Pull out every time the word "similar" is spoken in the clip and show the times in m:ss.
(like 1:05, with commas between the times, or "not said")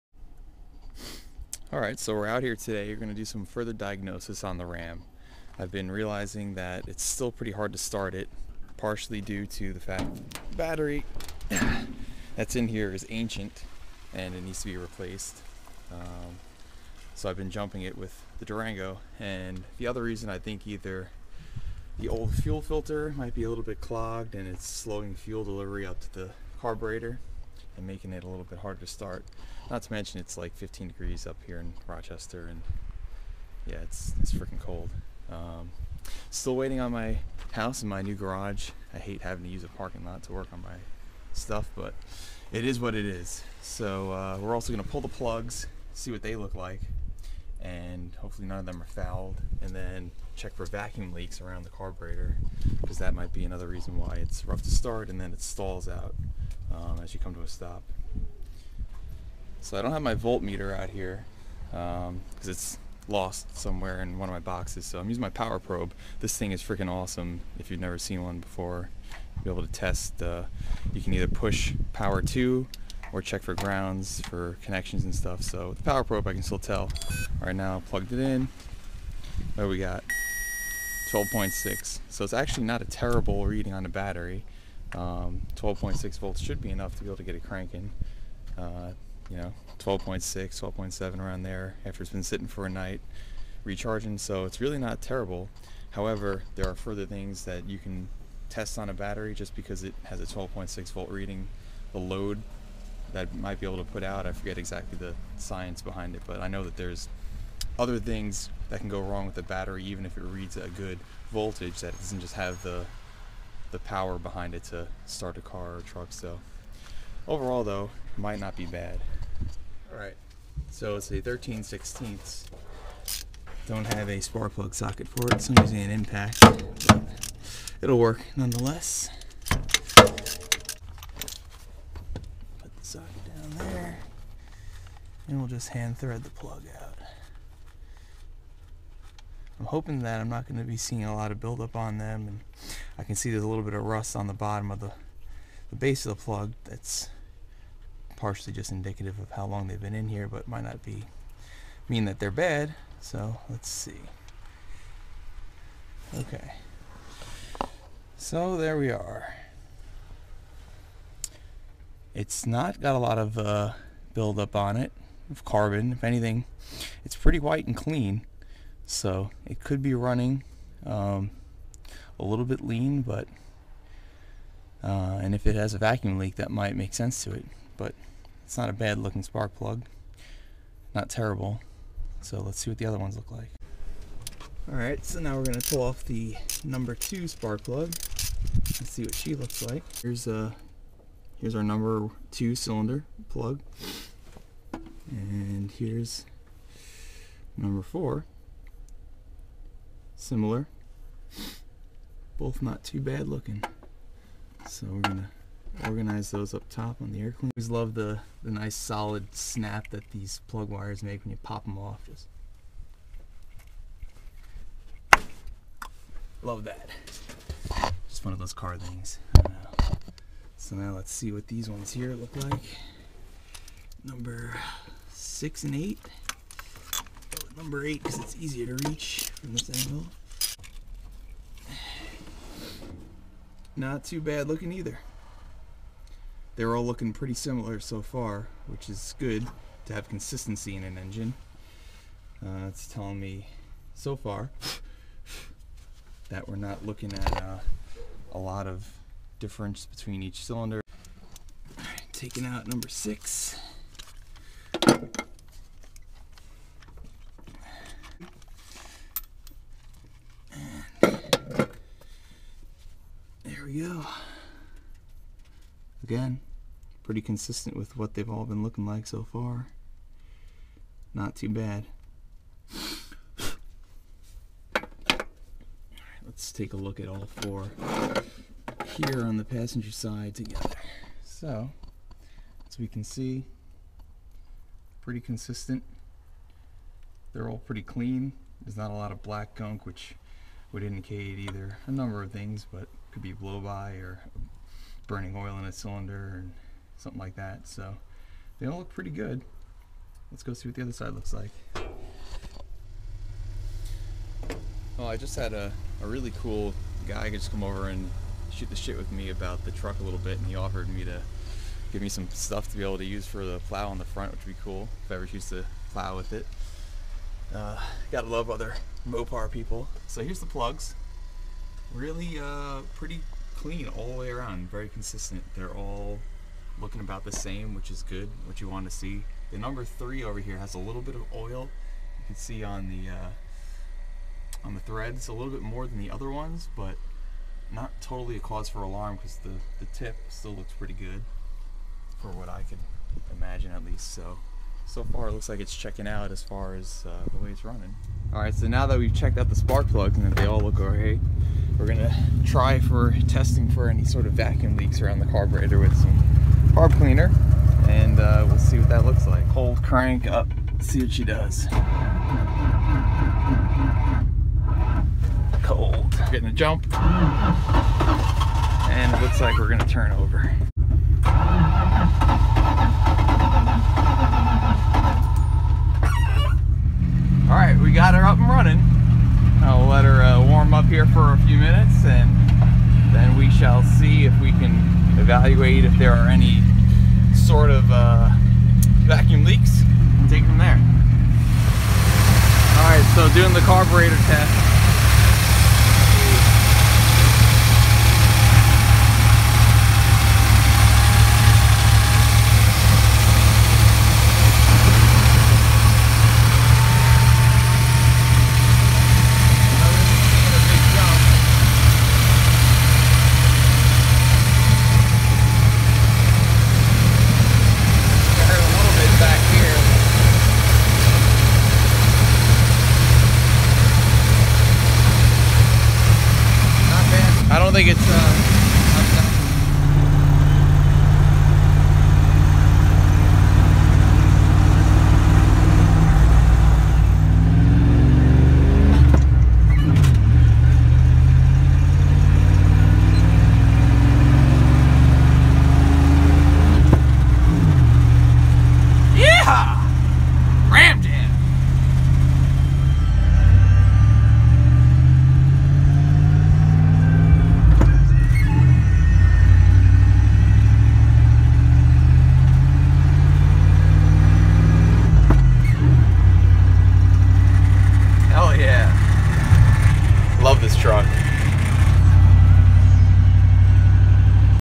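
3:20, 3:57.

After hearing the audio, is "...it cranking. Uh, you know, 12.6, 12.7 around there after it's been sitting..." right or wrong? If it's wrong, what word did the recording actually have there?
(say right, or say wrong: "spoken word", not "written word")
right.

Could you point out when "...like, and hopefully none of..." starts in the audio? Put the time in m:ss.
0:46.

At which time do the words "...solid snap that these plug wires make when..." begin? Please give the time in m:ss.
3:28.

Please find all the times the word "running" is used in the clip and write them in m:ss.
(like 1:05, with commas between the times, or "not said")
2:49, 5:47.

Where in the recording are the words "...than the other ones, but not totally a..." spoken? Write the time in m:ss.
5:35.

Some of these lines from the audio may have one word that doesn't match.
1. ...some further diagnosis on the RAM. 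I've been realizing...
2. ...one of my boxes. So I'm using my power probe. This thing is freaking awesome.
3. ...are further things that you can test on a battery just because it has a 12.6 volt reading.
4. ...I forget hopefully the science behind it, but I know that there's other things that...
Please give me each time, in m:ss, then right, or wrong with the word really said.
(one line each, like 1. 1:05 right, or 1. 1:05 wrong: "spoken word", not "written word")
1. 0:03 right
2. 1:04 right
3. 1:36 right
4. 1:44 wrong: "exactly", not "hopefully".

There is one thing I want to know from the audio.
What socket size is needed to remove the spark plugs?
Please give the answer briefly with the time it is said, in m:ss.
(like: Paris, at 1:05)
13/16, at 2:01.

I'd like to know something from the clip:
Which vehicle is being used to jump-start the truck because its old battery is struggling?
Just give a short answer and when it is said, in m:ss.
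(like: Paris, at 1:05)
Durango, at 0:18.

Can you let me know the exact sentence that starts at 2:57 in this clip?
But it's not a bad looking spark plug, not terrible.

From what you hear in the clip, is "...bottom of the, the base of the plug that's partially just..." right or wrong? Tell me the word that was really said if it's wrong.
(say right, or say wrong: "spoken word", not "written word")
right.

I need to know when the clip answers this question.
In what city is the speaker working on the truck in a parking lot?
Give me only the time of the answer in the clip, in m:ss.
0:31.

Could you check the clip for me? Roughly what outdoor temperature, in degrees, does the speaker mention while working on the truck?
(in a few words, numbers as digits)
15.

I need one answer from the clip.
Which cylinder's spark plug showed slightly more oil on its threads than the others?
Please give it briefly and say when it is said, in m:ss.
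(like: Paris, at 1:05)
number three, at 5:29.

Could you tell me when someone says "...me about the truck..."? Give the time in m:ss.
5:09.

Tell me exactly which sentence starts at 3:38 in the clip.
Just one of those car things.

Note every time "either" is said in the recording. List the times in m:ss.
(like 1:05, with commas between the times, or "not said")
0:20, 1:11, 3:54, 4:51.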